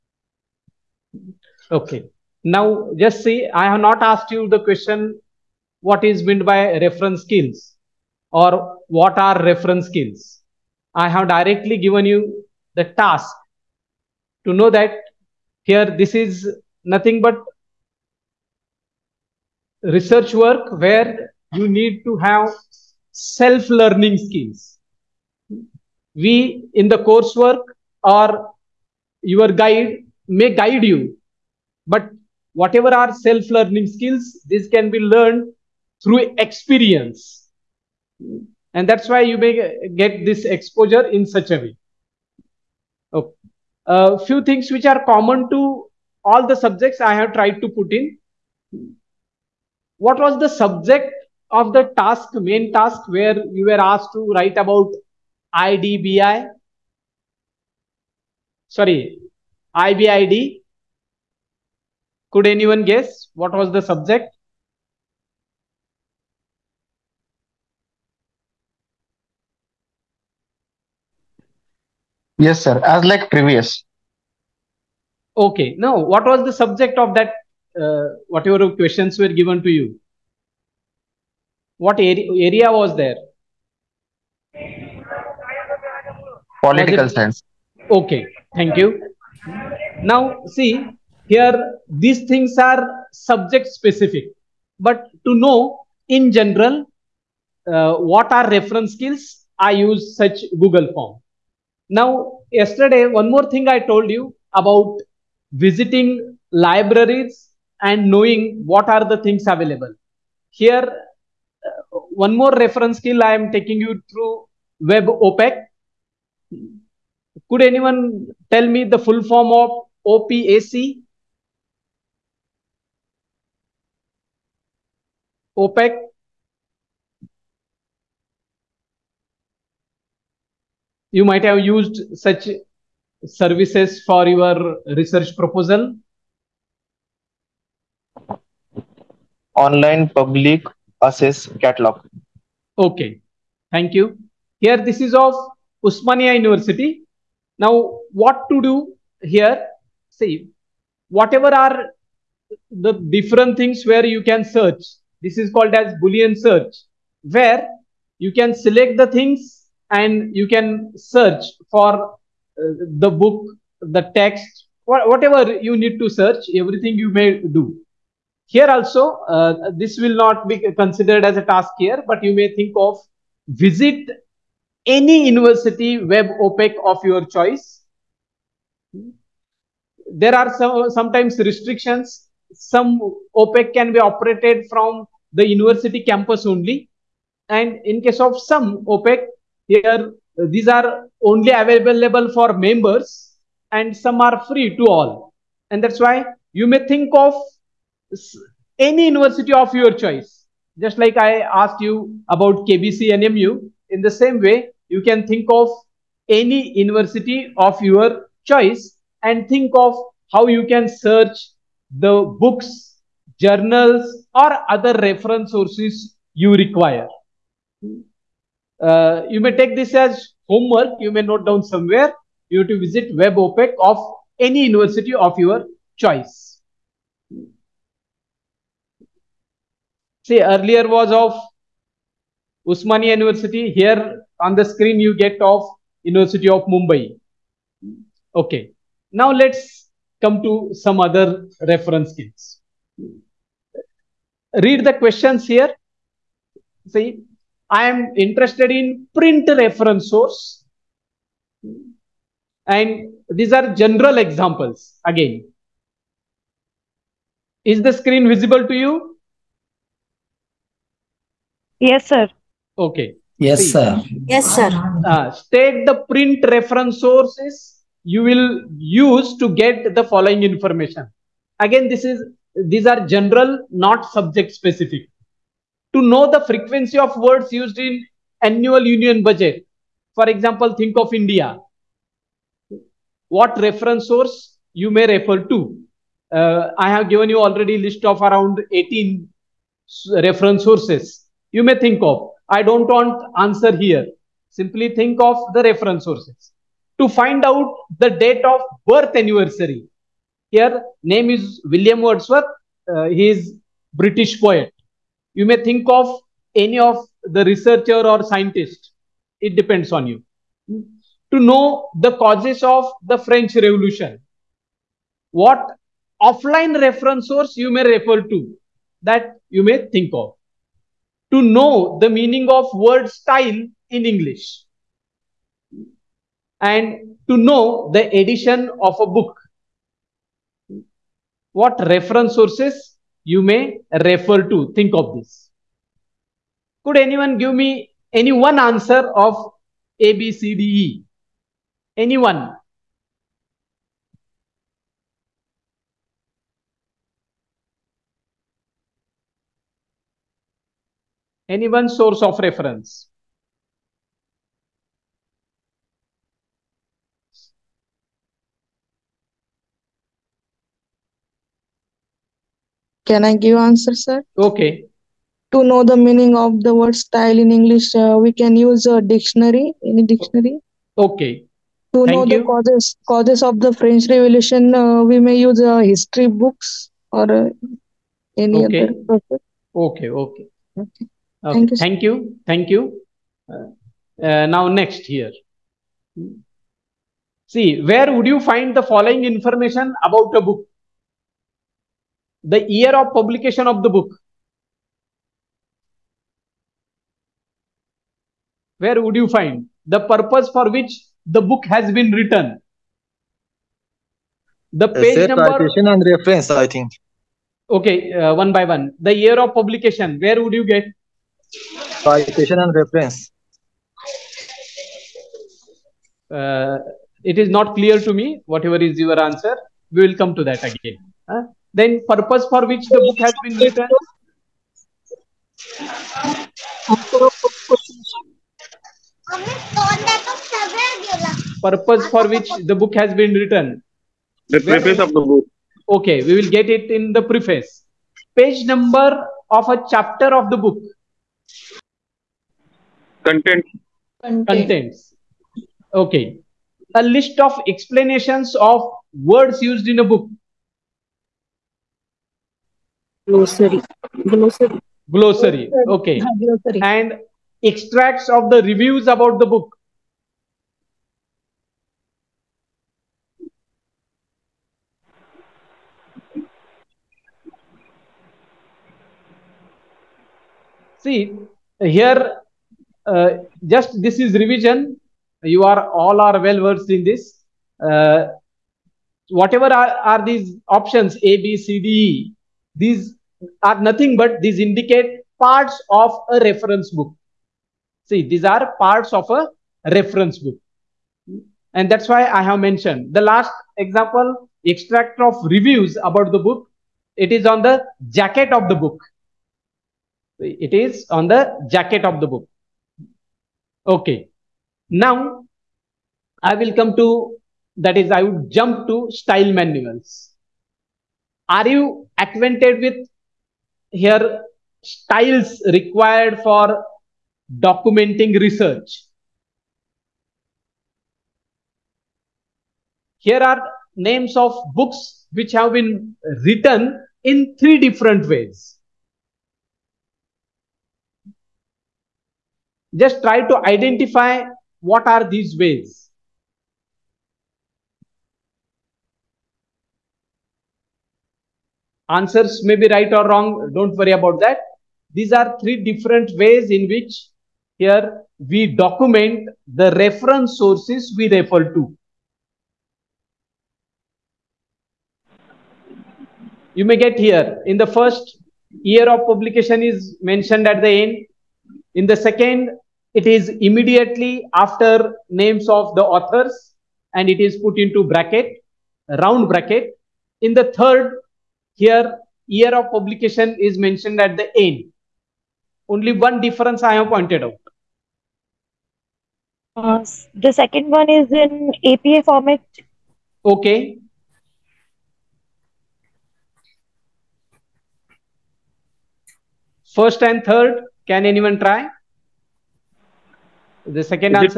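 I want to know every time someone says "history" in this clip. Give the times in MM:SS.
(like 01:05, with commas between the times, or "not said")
06:15.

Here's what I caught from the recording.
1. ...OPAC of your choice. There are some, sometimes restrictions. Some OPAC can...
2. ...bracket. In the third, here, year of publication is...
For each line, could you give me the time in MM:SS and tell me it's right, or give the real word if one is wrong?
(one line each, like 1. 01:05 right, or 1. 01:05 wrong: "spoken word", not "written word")
1. 02:56 right
2. 09:29 right.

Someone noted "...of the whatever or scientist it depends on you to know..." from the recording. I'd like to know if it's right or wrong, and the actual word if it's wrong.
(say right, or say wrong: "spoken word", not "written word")
wrong: "researcher", not "whatever".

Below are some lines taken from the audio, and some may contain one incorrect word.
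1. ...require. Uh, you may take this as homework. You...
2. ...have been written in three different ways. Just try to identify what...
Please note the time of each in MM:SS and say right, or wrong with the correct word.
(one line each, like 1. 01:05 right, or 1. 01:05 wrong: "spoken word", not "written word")
1. 03:36 right
2. 08:45 right.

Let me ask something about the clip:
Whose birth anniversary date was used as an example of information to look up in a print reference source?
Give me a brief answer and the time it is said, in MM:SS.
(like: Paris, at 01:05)
William Wordsworth, at 05:01.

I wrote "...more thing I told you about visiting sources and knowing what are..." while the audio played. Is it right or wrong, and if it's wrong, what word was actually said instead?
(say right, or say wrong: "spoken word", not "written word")
wrong: "libraries", not "sources".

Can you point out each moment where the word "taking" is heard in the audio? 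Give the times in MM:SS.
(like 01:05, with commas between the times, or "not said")
01:53.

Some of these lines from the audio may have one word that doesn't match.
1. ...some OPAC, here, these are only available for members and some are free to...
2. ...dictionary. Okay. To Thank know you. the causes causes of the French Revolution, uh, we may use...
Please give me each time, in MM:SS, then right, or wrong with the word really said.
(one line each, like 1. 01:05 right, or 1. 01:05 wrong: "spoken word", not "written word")
1. 03:08 right
2. 06:10 right.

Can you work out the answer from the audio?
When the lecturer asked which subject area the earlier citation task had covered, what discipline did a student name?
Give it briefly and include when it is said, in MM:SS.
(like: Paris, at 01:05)
Political science, at 01:26.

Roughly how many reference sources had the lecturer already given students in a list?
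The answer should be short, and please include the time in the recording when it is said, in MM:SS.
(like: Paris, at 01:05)
18, at 04:48.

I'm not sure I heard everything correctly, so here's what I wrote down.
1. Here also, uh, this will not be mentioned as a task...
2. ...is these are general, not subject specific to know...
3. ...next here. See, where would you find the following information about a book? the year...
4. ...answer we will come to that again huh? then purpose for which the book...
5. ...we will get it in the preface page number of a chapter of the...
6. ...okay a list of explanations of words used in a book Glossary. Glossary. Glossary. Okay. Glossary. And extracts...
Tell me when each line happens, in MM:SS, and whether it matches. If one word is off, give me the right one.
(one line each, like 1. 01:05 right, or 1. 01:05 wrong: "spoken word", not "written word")
1. 02:48 wrong: "considered", not "mentioned"
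2. 04:32 right
3. 06:24 right
4. 06:59 right
5. 07:16 right
6. 07:25 right.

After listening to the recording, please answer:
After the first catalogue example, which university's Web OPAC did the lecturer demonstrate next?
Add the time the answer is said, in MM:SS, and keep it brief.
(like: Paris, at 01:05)
University of Mumbai, at 03:56.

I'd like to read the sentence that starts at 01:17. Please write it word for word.
Uh, whatever questions were given to you.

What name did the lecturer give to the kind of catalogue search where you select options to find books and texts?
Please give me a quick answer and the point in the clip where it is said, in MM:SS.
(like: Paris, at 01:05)
Boolean search, at 02:36.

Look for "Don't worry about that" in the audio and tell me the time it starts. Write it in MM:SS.
09:03.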